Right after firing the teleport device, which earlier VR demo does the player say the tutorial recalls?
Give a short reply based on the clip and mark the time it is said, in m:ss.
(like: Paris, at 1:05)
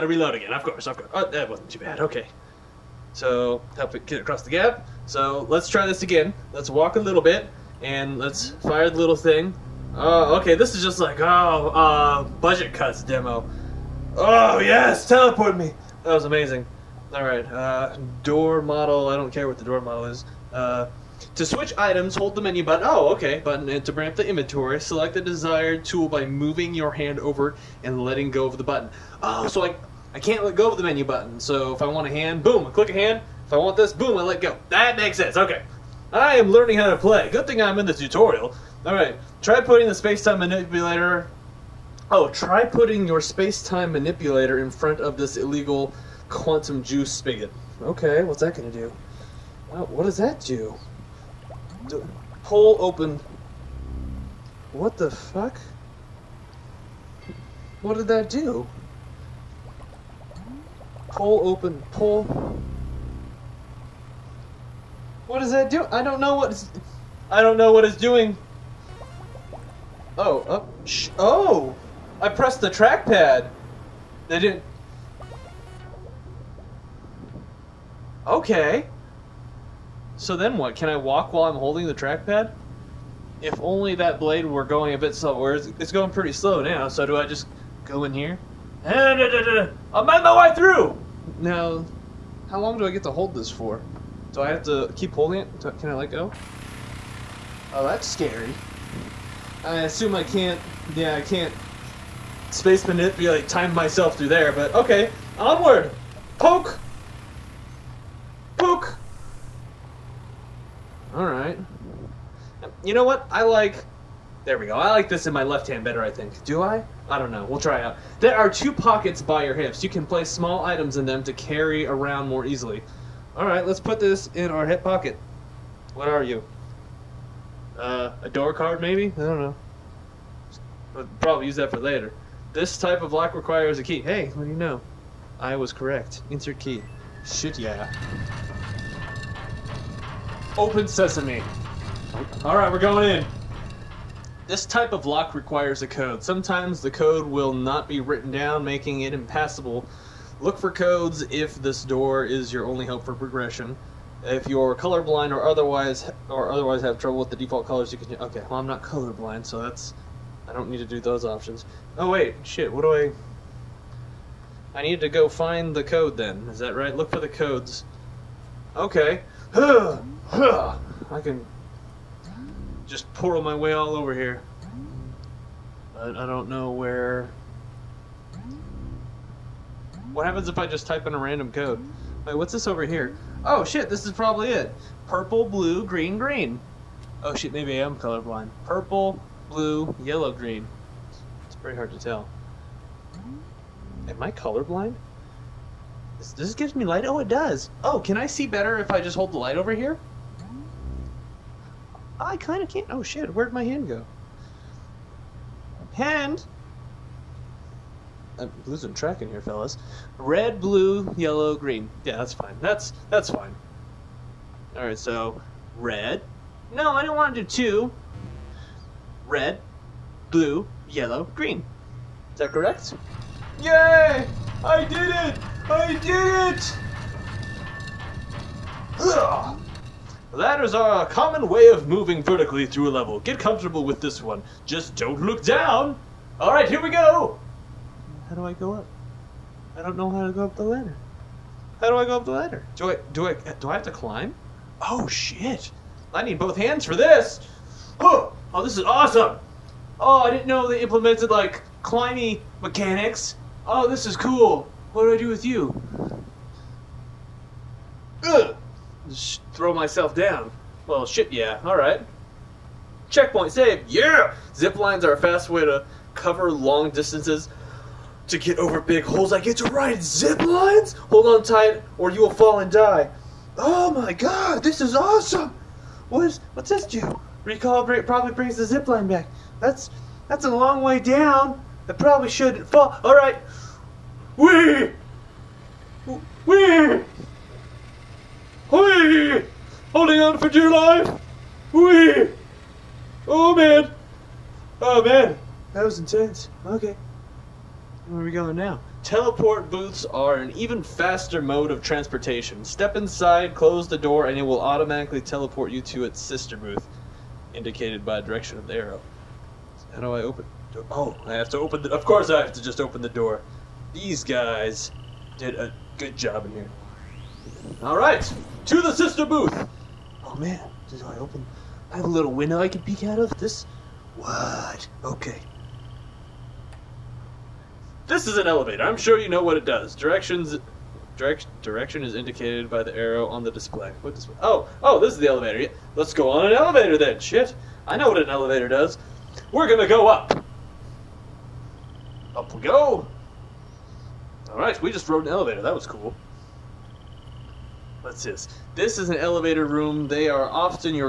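Budget Cuts demo, at 0:12.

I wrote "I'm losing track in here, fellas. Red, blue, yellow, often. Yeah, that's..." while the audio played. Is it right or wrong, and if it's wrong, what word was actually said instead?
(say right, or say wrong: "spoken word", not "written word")
wrong: "green", not "often".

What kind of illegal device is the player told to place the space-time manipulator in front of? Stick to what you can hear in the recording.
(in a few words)
quantum juice spigot.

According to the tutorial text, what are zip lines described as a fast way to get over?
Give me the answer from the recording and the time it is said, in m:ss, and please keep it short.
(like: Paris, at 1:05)
big holes, at 4:28.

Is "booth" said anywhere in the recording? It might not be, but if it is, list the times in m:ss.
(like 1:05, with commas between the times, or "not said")
4:59, 5:06, 5:19.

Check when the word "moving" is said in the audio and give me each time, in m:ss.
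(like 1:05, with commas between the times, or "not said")
0:26, 3:51.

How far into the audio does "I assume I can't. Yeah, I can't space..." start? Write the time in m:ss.
1:39.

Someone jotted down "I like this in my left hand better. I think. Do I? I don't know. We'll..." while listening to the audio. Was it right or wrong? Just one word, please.
right.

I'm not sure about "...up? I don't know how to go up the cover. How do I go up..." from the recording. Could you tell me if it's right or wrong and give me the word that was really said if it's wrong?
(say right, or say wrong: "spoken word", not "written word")
wrong: "ladder", not "cover".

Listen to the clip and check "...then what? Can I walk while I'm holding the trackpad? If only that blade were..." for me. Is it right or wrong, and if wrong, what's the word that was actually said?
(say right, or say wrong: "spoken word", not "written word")
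right.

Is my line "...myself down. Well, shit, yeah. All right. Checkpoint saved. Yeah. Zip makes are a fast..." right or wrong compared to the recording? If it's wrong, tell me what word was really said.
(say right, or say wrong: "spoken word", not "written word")
wrong: "lines", not "makes".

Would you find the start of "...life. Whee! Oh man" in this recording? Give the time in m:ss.
4:50.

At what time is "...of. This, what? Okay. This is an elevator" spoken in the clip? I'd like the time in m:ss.
5:23.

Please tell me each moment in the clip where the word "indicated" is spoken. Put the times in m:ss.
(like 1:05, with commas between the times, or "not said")
5:07, 5:32.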